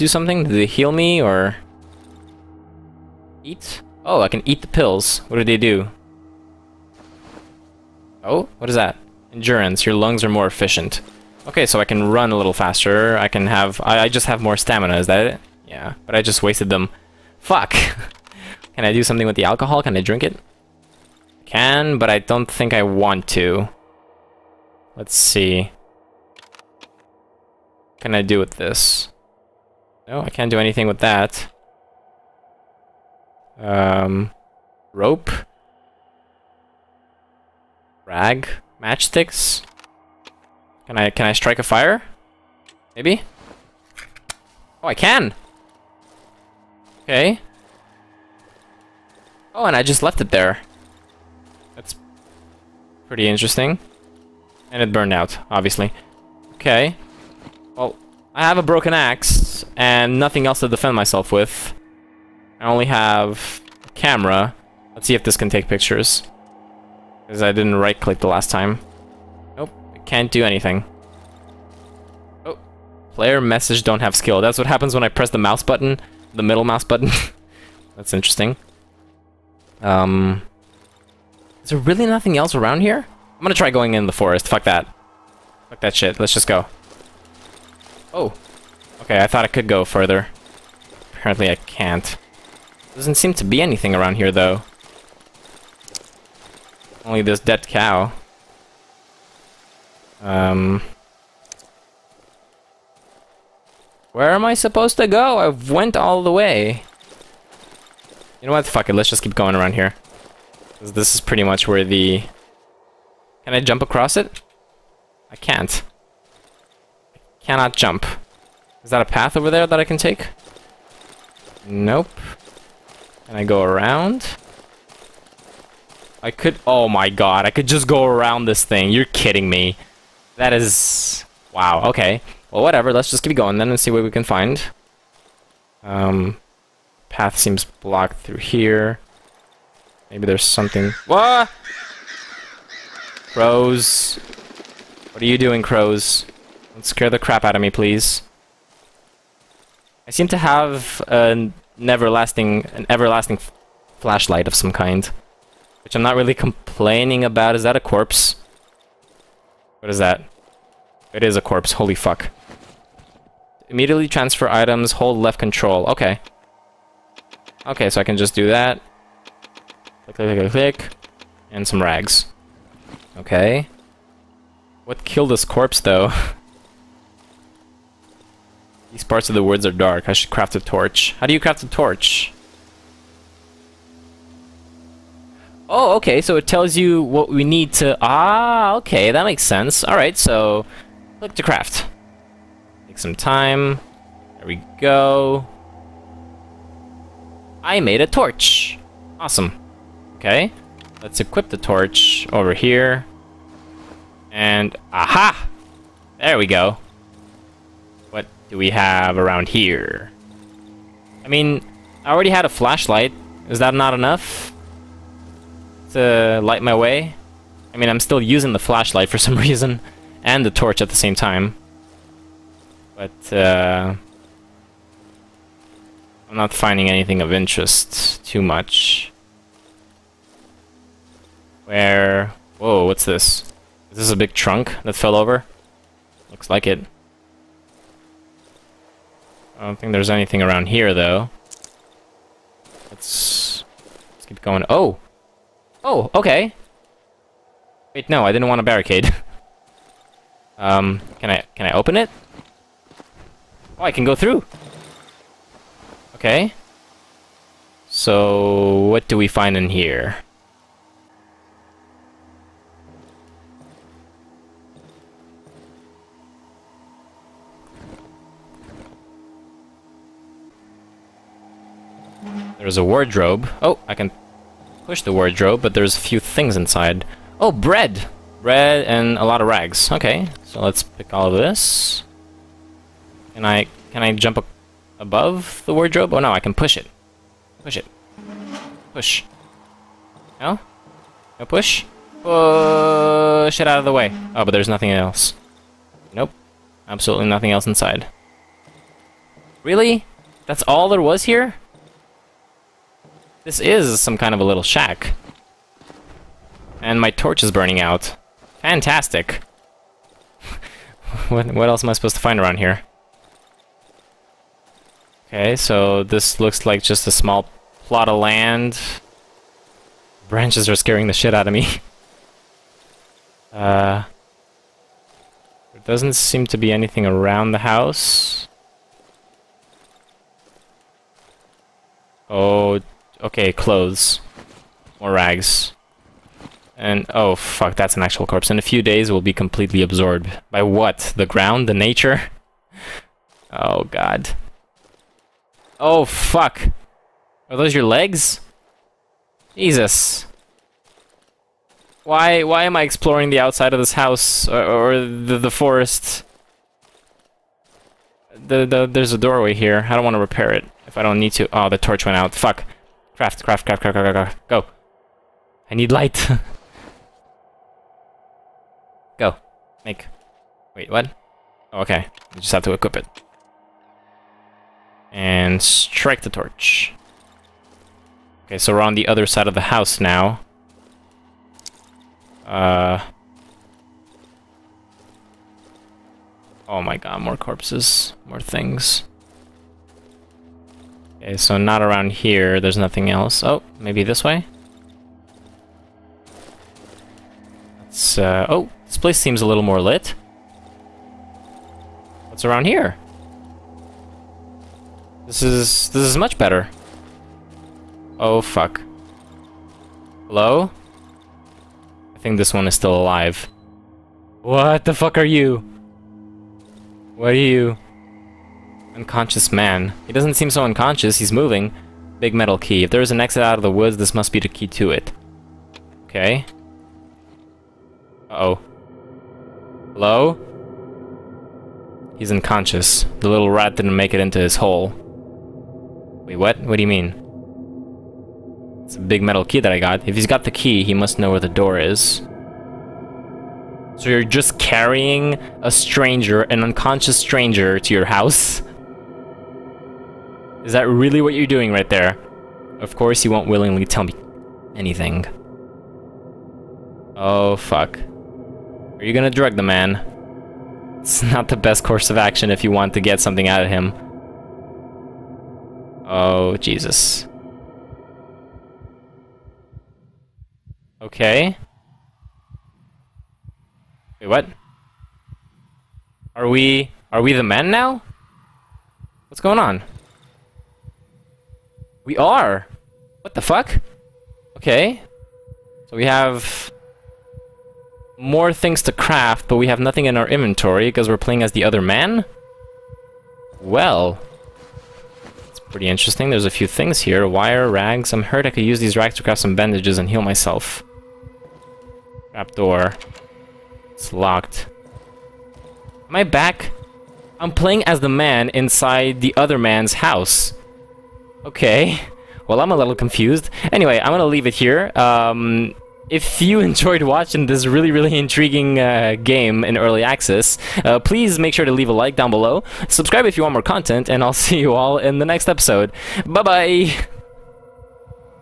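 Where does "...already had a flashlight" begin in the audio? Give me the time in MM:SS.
03:32.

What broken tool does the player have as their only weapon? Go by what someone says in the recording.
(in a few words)
Axe.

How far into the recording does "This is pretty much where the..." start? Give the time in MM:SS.
01:50.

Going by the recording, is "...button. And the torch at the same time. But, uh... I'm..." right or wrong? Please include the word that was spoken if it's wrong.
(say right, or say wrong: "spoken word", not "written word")
wrong: "reason", not "button".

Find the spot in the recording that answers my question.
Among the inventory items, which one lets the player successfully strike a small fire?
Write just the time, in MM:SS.
00:38.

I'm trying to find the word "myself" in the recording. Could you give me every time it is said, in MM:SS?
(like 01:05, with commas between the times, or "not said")
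01:00, 08:20.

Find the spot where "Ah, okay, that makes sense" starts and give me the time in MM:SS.
03:08.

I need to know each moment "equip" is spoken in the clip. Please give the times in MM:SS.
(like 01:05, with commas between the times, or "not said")
03:21, 06:12.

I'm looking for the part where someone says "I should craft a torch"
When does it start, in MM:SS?
03:00.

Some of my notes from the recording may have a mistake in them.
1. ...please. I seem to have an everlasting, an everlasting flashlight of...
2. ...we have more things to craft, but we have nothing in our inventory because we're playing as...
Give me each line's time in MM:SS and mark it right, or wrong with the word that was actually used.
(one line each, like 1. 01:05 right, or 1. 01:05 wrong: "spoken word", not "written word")
1. 02:27 right
2. 08:05 right.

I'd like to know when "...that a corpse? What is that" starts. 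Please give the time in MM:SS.
02:37.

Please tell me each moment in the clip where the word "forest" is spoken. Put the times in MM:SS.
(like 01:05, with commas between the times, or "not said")
01:24, 05:55.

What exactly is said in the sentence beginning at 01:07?
Because I didn't right-click the last time.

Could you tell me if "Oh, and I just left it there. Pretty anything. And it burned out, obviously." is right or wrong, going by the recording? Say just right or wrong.
wrong.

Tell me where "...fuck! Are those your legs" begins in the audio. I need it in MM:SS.
05:46.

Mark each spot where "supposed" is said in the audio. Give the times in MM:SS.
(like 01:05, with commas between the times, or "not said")
01:44, 05:11.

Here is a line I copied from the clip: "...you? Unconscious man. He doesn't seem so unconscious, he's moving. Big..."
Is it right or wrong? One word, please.
right.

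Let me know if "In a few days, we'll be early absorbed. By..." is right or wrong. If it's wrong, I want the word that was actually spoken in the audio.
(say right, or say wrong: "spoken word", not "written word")
wrong: "completely", not "early".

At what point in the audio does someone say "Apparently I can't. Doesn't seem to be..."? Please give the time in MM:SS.
01:31.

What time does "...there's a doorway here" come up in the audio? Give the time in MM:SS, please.
05:58.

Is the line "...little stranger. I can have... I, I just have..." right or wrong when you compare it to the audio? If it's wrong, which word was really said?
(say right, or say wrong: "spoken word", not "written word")
wrong: "faster", not "stranger".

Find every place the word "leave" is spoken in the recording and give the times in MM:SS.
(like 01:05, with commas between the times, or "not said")
08:34, 08:41.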